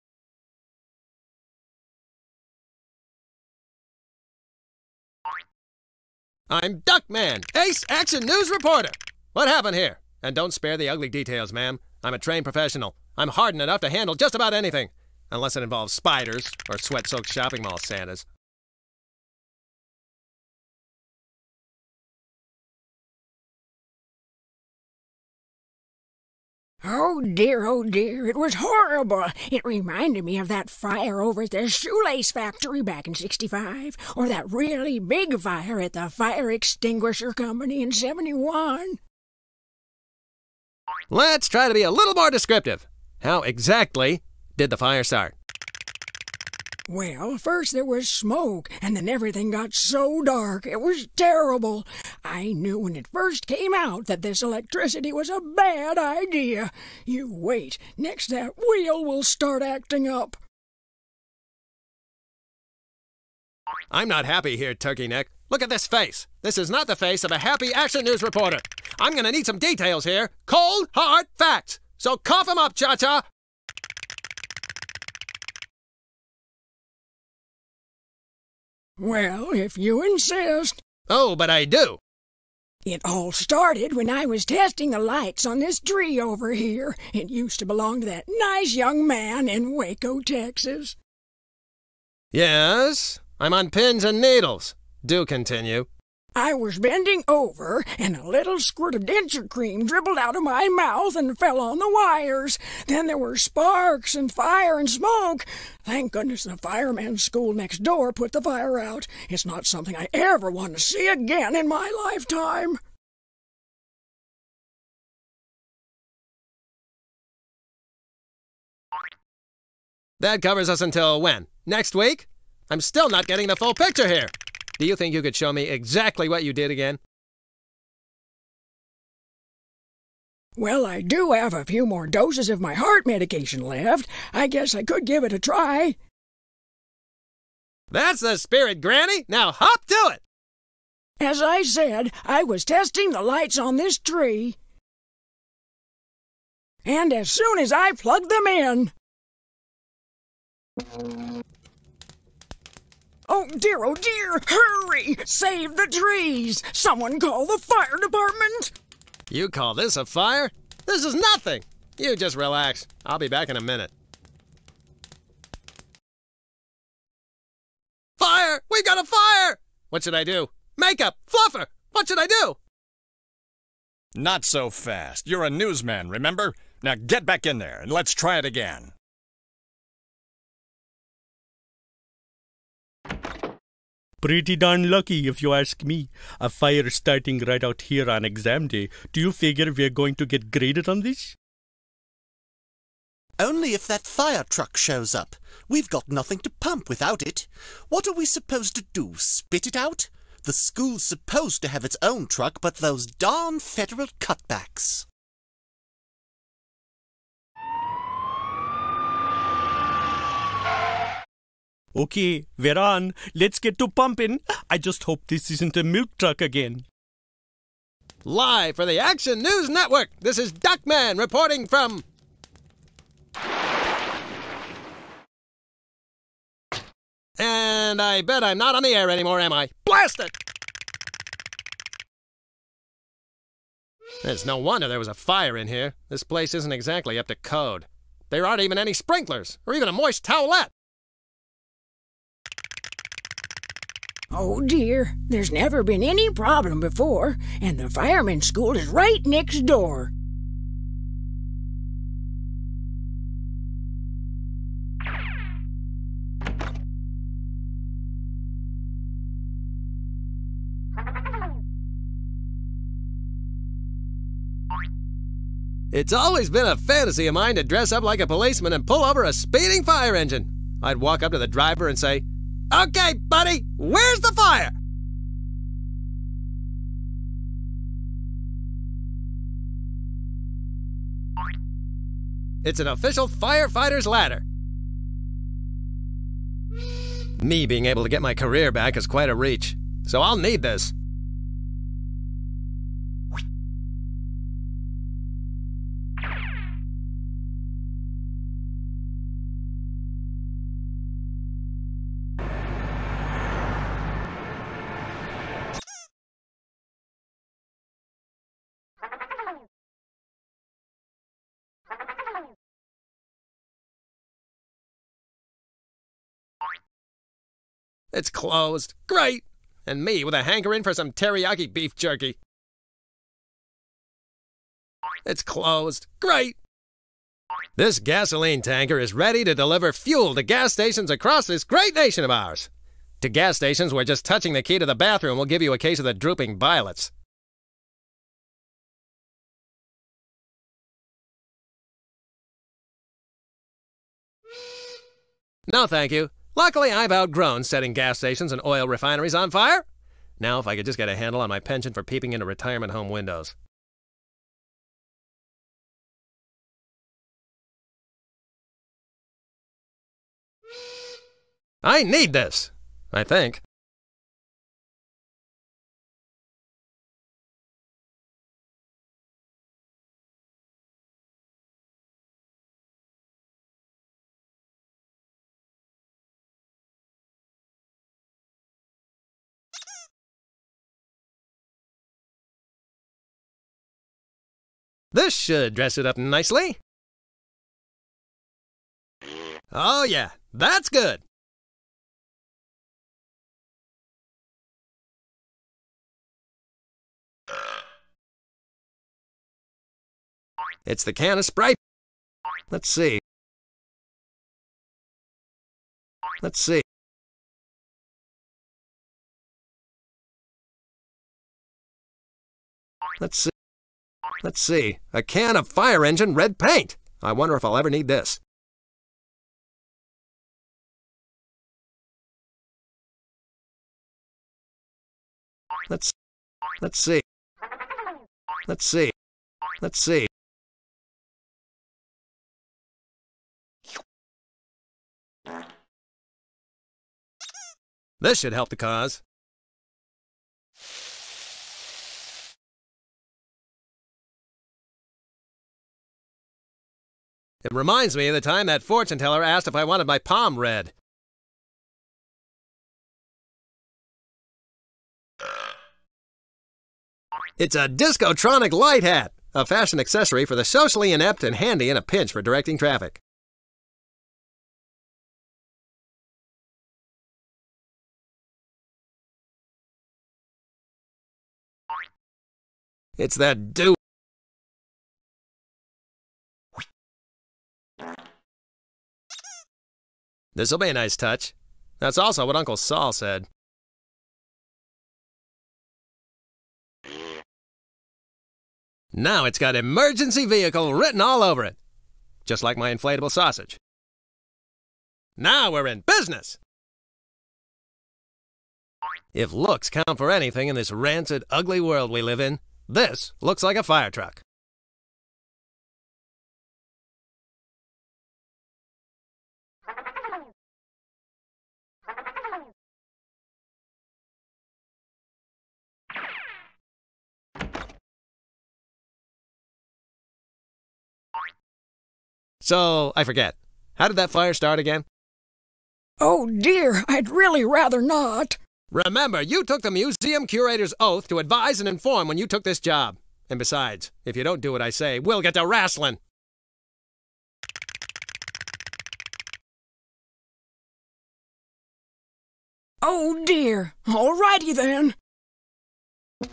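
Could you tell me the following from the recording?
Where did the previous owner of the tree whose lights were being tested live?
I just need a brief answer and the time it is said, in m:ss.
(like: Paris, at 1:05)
Waco, Texas, at 1:29.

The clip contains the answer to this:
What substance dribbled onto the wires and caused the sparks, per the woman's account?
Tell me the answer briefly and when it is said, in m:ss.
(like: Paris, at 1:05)
denture cream, at 1:39.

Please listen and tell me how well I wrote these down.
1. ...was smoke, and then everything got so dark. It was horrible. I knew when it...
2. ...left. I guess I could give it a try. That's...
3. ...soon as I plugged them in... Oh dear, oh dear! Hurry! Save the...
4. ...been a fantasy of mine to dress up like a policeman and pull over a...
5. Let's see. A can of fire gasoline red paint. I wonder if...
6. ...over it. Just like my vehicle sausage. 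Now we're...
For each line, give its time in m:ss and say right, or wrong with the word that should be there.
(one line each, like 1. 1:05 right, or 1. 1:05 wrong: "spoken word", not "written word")
1. 0:47 wrong: "terrible", not "horrible"
2. 2:13 right
3. 2:27 right
4. 4:26 right
5. 6:54 wrong: "engine", not "gasoline"
6. 8:11 wrong: "inflatable", not "vehicle".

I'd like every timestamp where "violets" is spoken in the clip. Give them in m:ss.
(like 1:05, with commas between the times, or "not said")
5:36.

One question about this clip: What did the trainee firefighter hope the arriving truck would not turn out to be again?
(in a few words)
a milk truck.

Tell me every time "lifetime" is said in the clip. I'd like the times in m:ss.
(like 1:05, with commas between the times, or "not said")
1:52.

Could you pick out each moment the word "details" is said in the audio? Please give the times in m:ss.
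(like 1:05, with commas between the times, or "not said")
0:11, 1:09.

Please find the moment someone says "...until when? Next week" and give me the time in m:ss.
2:00.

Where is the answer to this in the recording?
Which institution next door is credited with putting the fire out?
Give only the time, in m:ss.
1:46.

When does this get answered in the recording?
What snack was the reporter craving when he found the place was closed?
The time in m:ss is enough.
5:21.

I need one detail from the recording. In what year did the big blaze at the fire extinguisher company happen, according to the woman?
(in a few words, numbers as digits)
1971.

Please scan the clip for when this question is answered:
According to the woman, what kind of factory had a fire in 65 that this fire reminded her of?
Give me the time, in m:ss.
0:31.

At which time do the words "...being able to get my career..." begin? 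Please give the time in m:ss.
4:47.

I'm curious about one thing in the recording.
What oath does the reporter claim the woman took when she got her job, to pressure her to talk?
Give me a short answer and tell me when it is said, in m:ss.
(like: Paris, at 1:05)
museum curator's oath, at 8:49.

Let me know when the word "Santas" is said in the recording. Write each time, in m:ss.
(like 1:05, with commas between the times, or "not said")
0:17.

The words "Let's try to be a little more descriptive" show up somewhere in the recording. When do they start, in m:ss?
0:41.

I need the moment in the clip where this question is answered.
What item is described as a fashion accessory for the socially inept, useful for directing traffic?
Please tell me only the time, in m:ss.
7:37.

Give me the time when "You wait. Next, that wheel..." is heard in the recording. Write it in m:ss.
0:57.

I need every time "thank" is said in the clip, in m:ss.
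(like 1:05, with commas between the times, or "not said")
1:45, 5:45.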